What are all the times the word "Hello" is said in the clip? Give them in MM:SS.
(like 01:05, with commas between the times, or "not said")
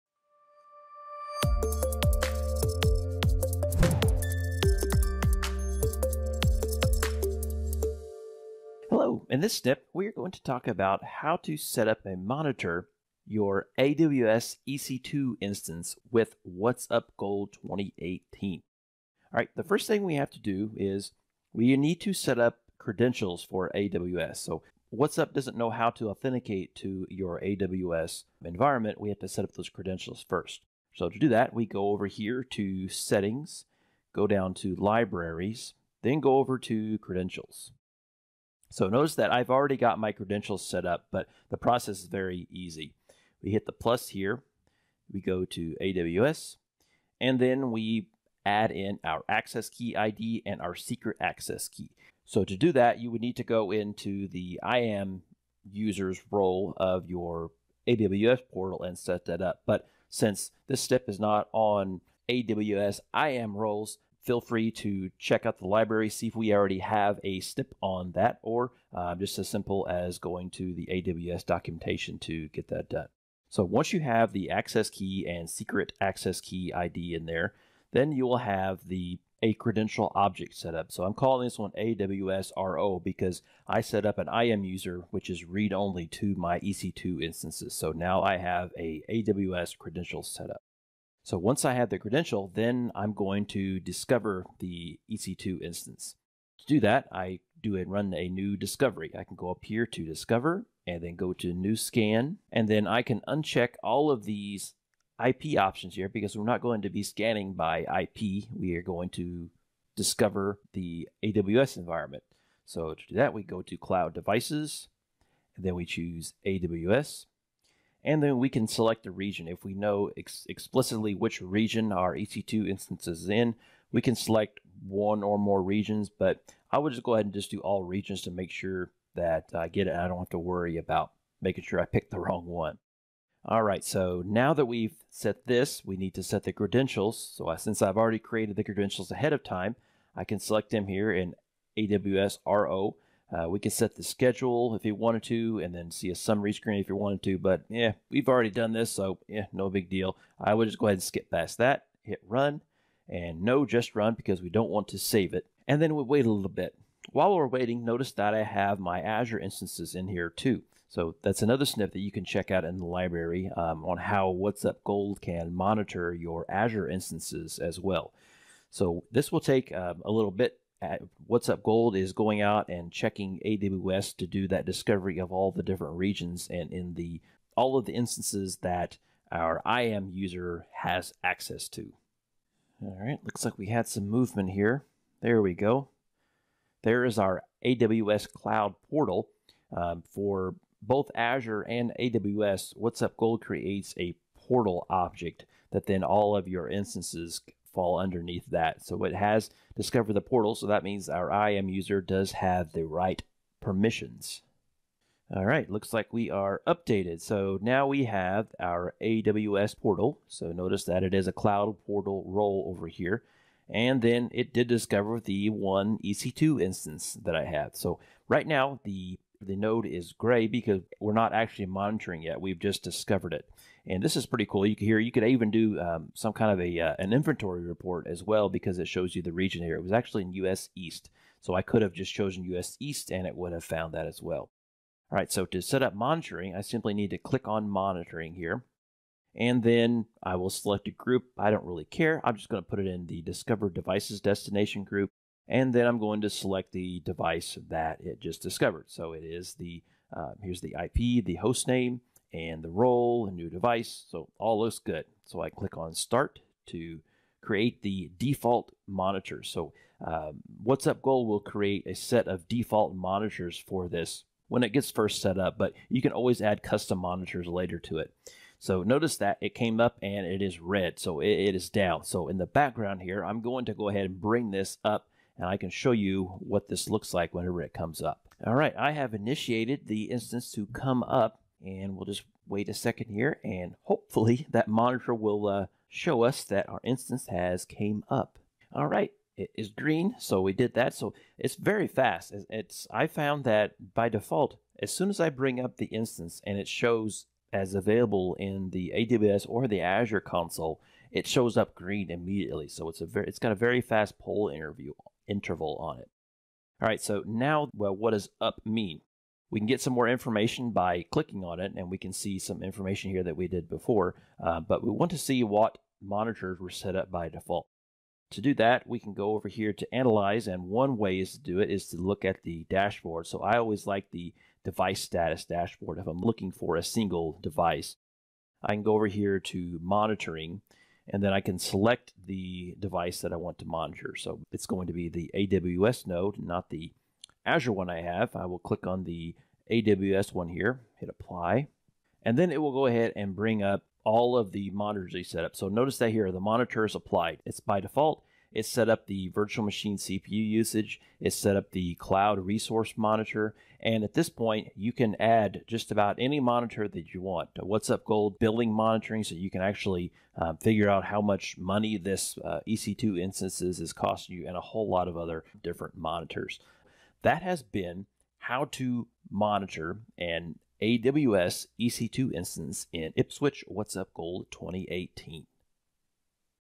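00:08.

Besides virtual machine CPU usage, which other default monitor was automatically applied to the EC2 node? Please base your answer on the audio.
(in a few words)
cloud resource monitor.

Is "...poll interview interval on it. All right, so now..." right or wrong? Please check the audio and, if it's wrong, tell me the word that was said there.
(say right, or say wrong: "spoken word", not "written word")
right.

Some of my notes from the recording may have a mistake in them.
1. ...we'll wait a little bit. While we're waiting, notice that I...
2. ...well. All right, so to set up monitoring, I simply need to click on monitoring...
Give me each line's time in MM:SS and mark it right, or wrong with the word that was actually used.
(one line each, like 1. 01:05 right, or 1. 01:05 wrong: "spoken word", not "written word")
1. 02:35 right
2. 03:54 right.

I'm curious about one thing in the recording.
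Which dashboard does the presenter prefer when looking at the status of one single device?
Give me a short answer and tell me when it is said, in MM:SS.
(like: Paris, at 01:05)
device status dashboard, at 05:24.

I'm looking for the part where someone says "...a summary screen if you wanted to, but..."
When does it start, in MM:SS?
02:26.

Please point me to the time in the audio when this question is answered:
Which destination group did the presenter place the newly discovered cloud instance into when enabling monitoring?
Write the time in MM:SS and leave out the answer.
04:03.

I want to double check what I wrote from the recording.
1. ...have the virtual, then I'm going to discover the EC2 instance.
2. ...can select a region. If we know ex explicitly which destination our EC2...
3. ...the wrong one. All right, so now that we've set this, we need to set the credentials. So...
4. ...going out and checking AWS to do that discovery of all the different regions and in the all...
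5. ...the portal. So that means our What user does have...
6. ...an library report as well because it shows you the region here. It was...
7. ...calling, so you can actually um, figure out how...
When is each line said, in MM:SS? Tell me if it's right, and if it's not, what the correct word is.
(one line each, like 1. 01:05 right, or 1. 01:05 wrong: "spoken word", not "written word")
1. 01:31 wrong: "credential", not "virtual"
2. 01:58 wrong: "region", not "destination"
3. 02:12 right
4. 02:52 right
5. 03:20 wrong: "IAM", not "What"
6. 03:46 wrong: "inventory", not "library"
7. 05:58 wrong: "monitoring", not "calling".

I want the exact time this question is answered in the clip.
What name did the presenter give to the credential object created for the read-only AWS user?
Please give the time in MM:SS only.
01:21.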